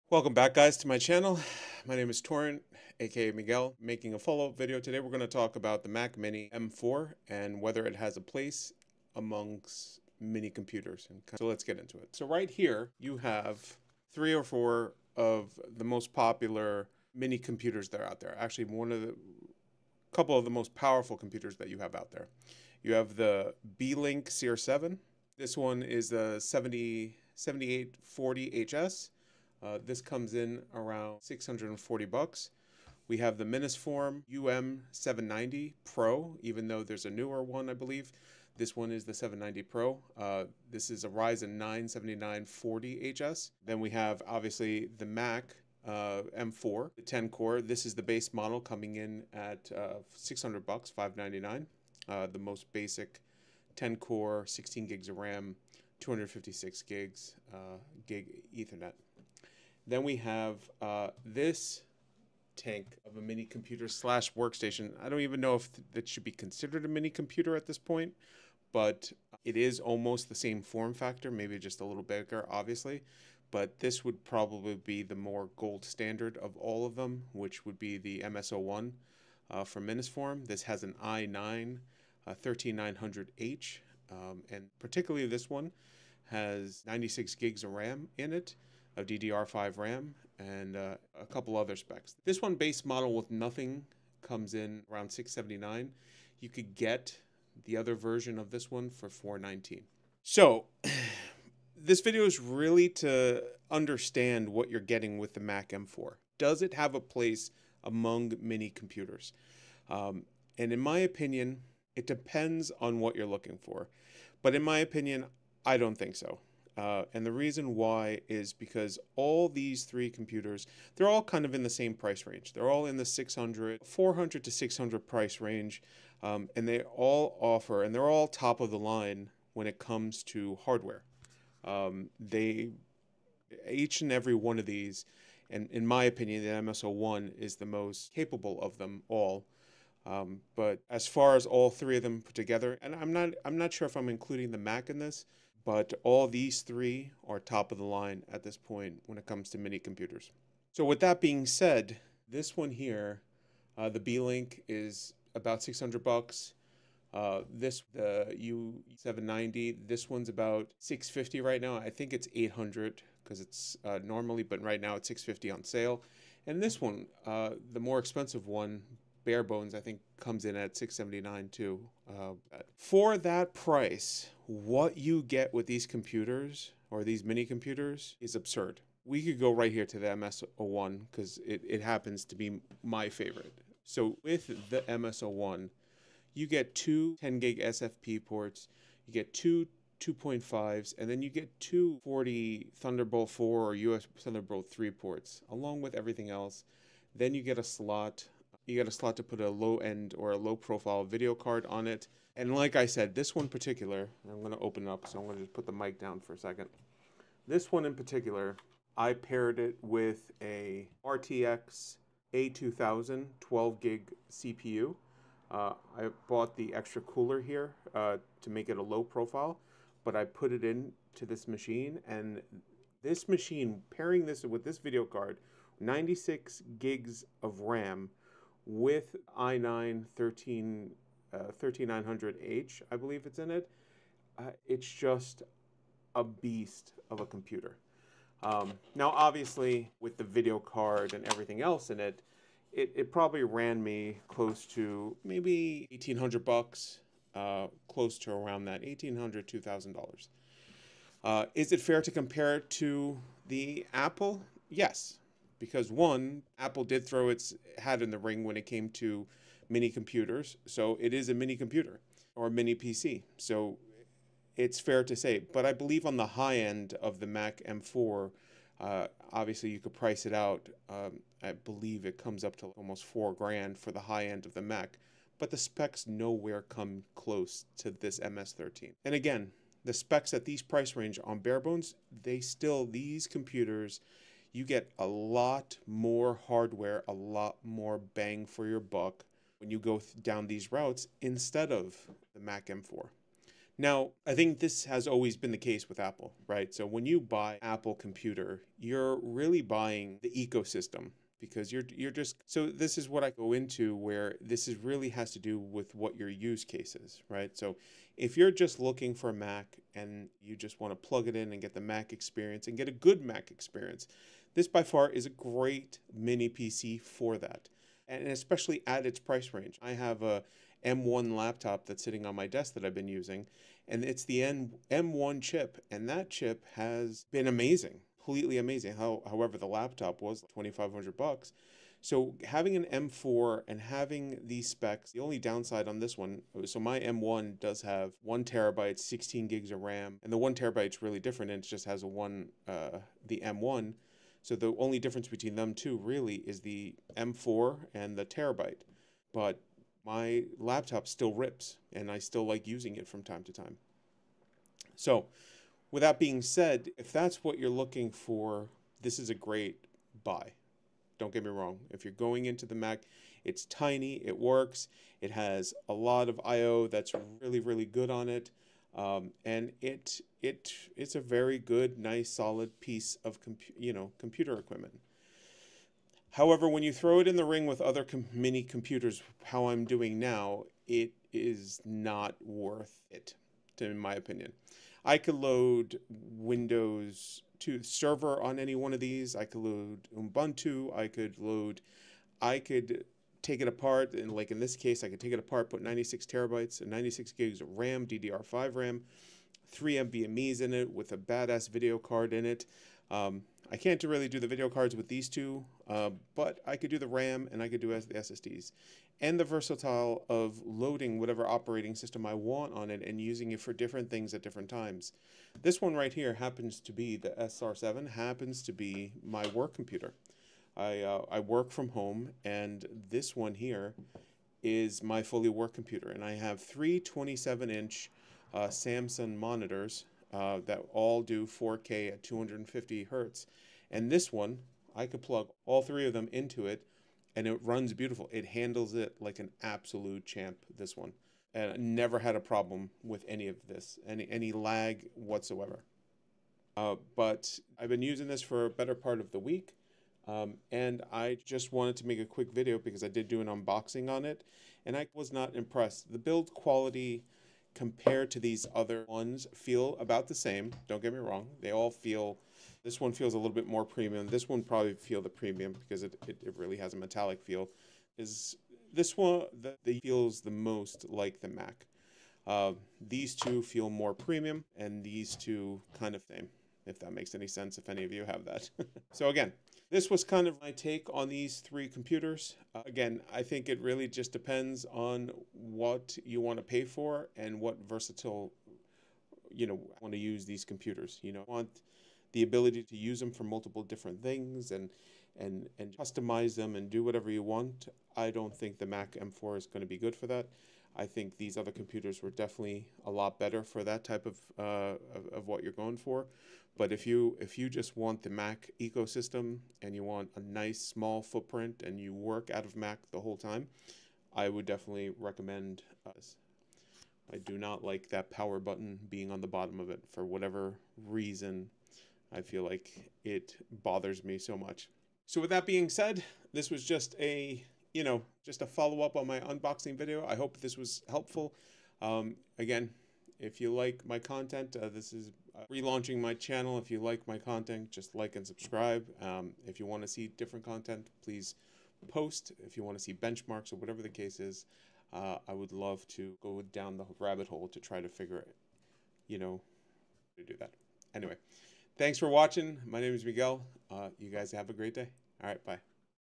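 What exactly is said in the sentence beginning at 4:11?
Uh, is it fair to compare it to the Apple?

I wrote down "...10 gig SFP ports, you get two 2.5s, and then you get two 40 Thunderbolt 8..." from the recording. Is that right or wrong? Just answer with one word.
wrong.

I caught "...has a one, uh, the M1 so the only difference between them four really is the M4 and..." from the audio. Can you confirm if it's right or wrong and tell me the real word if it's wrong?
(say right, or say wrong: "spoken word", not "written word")
wrong: "two", not "four".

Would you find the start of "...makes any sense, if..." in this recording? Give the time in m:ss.
7:57.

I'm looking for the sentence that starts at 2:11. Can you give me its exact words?
Um, they, each and every one of these, and in my opinion, the MS01 is the most capable of them all.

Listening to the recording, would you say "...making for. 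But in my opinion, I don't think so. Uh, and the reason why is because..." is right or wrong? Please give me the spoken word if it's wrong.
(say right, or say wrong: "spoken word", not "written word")
wrong: "looking", not "making".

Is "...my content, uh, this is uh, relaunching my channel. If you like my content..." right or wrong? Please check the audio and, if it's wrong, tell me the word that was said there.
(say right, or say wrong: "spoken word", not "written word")
right.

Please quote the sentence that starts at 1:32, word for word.
This one base model with nothing comes in around 679.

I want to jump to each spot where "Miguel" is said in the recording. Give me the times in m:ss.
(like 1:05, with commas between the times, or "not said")
0:03, 9:13.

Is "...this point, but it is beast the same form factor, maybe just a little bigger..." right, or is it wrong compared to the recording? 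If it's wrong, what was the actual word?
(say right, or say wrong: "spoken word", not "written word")
wrong: "almost", not "beast".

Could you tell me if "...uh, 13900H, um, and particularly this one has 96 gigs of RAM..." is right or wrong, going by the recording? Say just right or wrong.
right.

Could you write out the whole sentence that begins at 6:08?
Um, and it it it's a very good, nice, solid piece of compu- you know computer equipment.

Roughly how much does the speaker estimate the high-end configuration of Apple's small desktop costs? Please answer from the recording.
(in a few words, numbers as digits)
4 grand.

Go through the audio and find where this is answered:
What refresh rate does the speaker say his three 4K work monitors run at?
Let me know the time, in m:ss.
7:12.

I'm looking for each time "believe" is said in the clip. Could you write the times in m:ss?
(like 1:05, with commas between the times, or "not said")
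0:37, 3:52, 4:25, 4:31.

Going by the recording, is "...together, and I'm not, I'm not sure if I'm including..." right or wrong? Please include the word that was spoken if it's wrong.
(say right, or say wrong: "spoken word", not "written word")
right.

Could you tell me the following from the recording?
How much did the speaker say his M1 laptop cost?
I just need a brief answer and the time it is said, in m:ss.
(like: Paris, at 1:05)
$2,500, at 5:30.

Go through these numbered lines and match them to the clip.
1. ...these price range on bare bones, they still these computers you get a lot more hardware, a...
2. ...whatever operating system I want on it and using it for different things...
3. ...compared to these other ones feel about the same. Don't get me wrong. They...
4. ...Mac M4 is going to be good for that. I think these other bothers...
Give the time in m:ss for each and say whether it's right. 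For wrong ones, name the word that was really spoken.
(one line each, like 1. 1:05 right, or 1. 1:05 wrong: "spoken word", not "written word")
1. 4:40 right
2. 6:51 right
3. 7:37 right
4. 8:18 wrong: "computers", not "bothers".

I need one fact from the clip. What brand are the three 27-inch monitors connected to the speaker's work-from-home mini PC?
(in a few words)
Samsung.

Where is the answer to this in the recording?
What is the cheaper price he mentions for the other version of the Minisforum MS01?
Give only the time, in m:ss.
1:39.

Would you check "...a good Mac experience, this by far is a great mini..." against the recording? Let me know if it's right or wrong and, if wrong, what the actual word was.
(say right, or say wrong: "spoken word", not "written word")
right.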